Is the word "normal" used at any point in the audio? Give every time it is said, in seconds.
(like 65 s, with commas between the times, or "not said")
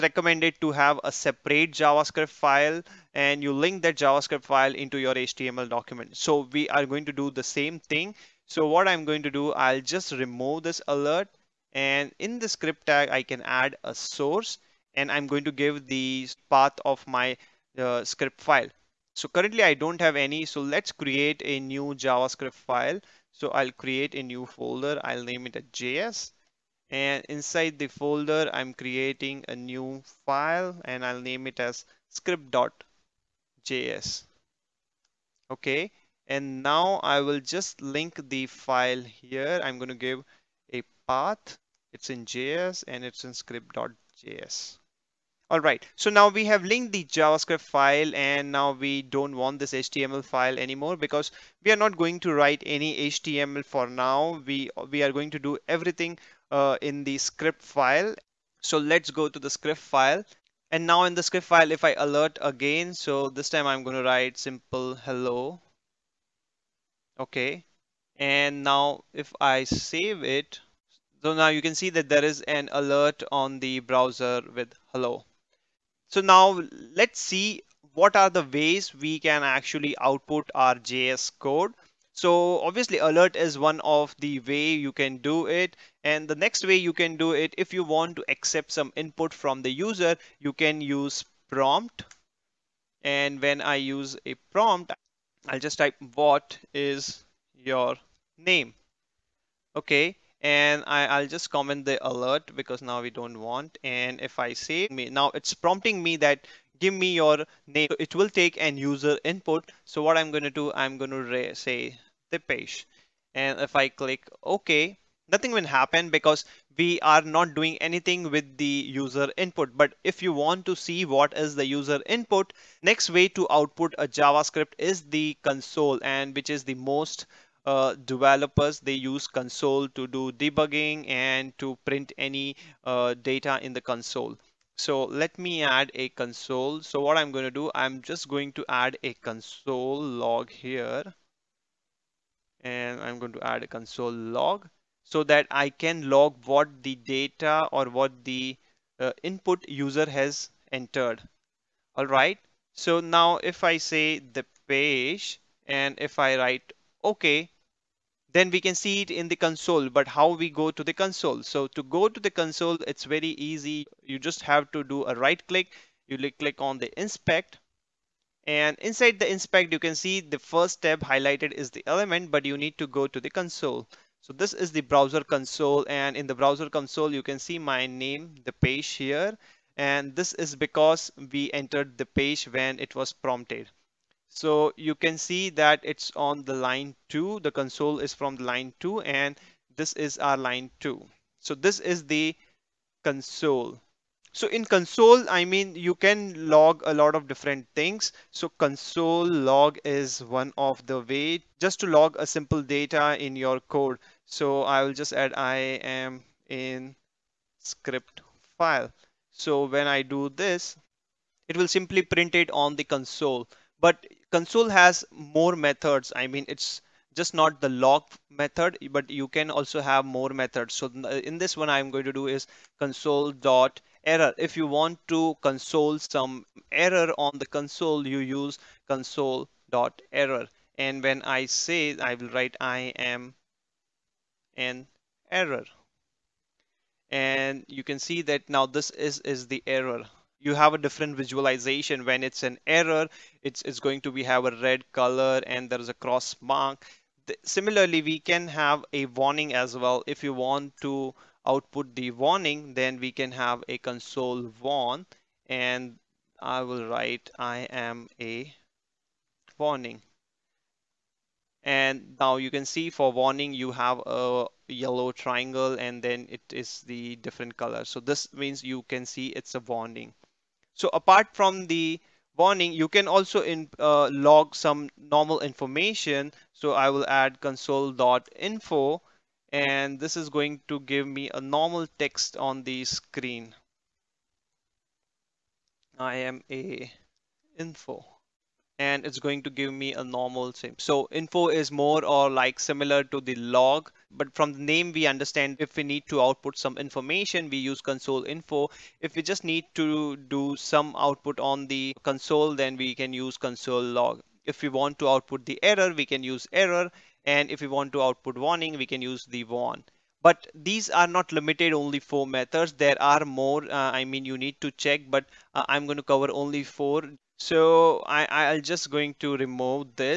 274 s, 281 s, 290 s.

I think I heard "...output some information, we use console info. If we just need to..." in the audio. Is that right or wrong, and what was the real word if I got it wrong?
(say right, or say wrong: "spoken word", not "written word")
right.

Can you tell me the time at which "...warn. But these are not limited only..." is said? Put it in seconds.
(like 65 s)
309 s.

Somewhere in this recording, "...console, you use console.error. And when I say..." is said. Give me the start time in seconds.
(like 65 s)
227 s.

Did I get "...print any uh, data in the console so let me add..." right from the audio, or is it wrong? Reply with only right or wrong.
right.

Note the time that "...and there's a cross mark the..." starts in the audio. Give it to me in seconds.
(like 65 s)
245 s.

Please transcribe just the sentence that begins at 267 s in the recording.
So this means you can see it's a warning.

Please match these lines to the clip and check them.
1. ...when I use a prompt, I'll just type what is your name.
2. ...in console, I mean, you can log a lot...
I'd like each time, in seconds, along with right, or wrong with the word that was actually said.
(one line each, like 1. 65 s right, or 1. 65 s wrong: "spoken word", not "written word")
1. 93 s right
2. 194 s right.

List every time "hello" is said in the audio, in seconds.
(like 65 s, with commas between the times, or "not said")
64 s, 74 s.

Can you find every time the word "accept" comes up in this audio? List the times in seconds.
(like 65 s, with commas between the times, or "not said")
88 s.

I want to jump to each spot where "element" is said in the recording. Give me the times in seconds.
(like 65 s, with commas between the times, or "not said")
171 s.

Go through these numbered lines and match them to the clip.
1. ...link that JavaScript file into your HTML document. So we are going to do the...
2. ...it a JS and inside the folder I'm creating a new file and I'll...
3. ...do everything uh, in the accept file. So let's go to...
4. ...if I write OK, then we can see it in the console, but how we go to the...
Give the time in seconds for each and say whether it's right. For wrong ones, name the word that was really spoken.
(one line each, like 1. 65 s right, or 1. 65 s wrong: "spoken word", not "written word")
1. 3 s right
2. 25 s right
3. 55 s wrong: "script", not "accept"
4. 155 s right.